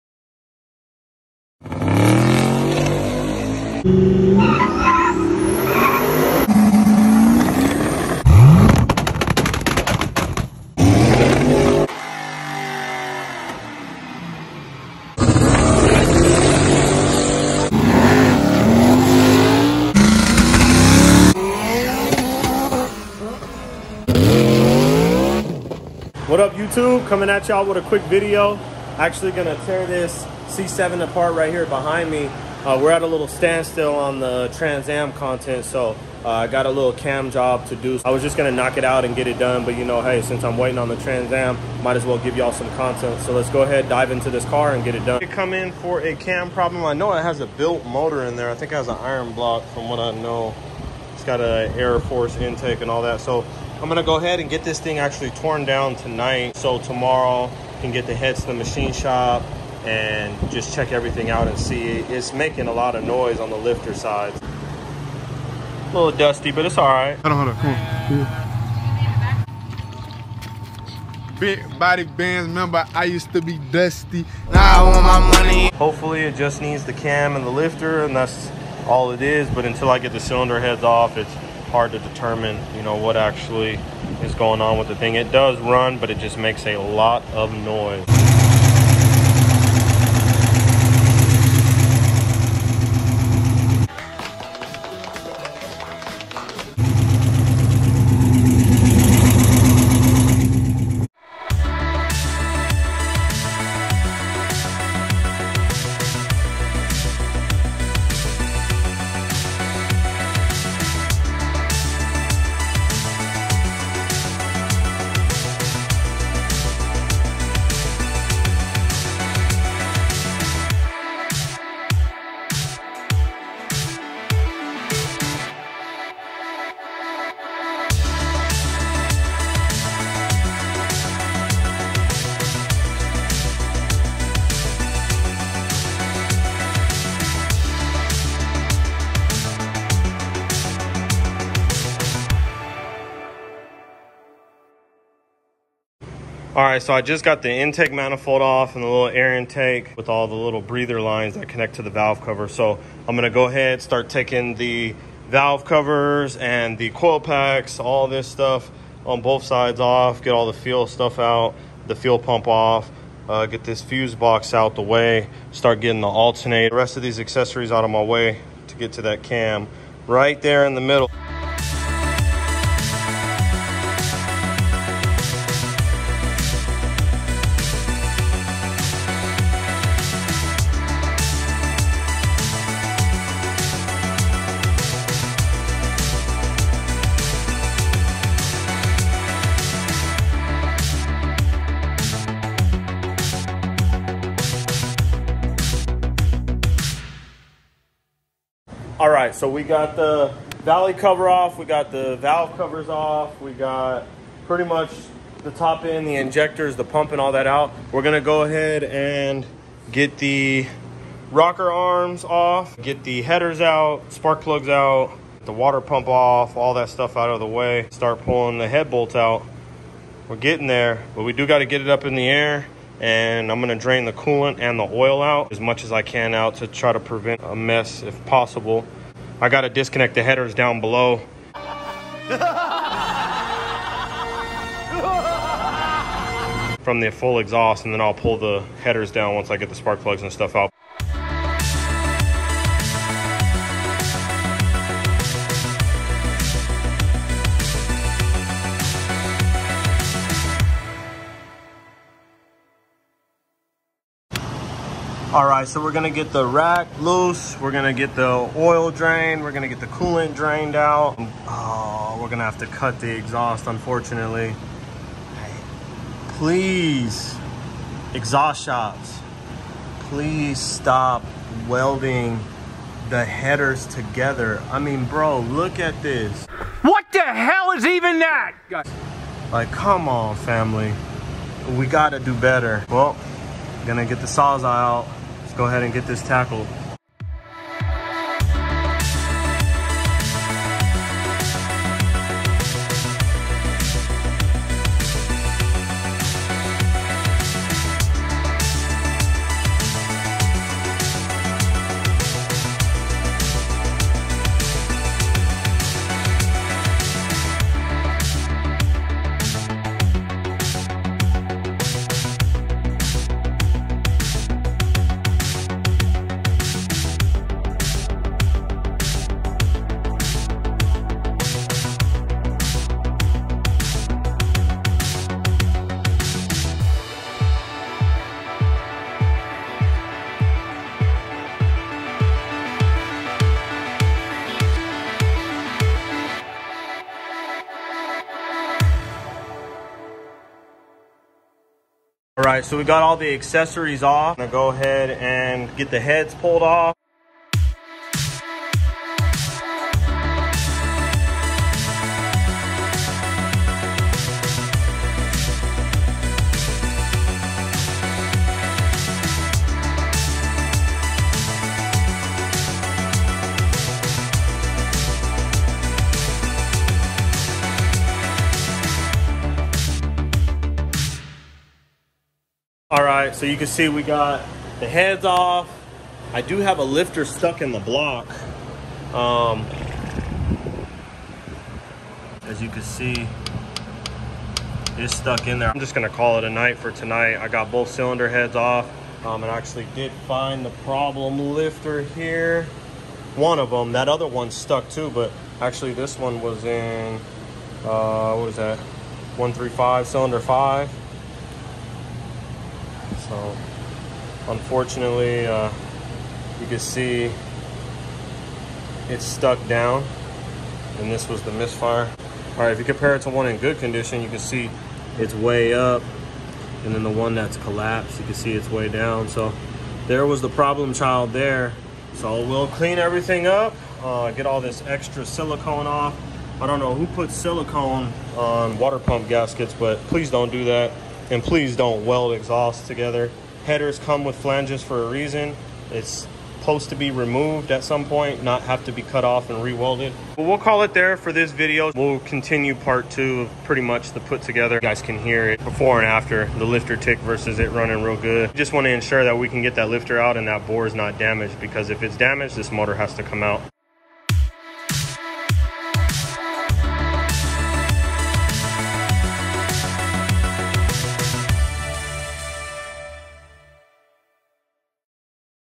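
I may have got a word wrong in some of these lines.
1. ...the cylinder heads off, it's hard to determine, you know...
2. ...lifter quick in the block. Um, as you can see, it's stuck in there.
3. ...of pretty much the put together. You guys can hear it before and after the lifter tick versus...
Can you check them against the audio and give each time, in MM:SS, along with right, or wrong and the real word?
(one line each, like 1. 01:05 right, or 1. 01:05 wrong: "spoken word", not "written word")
1. 01:20 right
2. 06:16 wrong: "stuck", not "quick"
3. 07:23 right.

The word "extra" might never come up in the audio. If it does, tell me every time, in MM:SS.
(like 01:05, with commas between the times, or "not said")
07:04.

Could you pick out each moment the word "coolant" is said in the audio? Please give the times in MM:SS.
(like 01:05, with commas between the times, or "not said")
03:44, 04:19.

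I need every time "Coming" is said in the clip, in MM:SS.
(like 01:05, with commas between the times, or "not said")
00:27.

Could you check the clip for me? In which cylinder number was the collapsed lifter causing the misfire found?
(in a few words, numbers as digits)
5.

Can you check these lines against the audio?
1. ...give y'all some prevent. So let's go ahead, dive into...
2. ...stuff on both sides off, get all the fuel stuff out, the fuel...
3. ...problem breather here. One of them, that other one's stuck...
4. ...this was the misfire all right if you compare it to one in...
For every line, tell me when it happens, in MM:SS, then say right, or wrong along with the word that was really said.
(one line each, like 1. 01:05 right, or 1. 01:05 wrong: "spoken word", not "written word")
1. 00:42 wrong: "content", not "prevent"
2. 02:38 right
3. 06:30 wrong: "lifter", not "breather"
4. 06:51 right.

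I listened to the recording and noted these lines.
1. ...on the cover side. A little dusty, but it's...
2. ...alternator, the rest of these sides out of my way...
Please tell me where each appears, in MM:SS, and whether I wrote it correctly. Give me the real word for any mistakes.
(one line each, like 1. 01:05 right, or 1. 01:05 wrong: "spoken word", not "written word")
1. 01:03 wrong: "lifter", not "cover"
2. 02:46 wrong: "accessories", not "sides".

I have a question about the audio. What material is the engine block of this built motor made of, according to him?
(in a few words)
Iron.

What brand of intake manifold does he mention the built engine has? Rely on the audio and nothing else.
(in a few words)
Air Force.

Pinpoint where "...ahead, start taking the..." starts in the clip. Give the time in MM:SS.
02:33.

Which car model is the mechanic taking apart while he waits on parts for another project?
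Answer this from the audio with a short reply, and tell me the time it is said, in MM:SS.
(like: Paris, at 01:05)
C7, at 00:30.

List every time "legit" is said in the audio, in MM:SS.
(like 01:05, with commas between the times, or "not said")
not said.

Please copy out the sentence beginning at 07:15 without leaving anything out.
It's supposed to be removed at some point, not have to be cut off and rewelded.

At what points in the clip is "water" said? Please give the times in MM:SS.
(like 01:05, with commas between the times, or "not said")
03:35, 07:08.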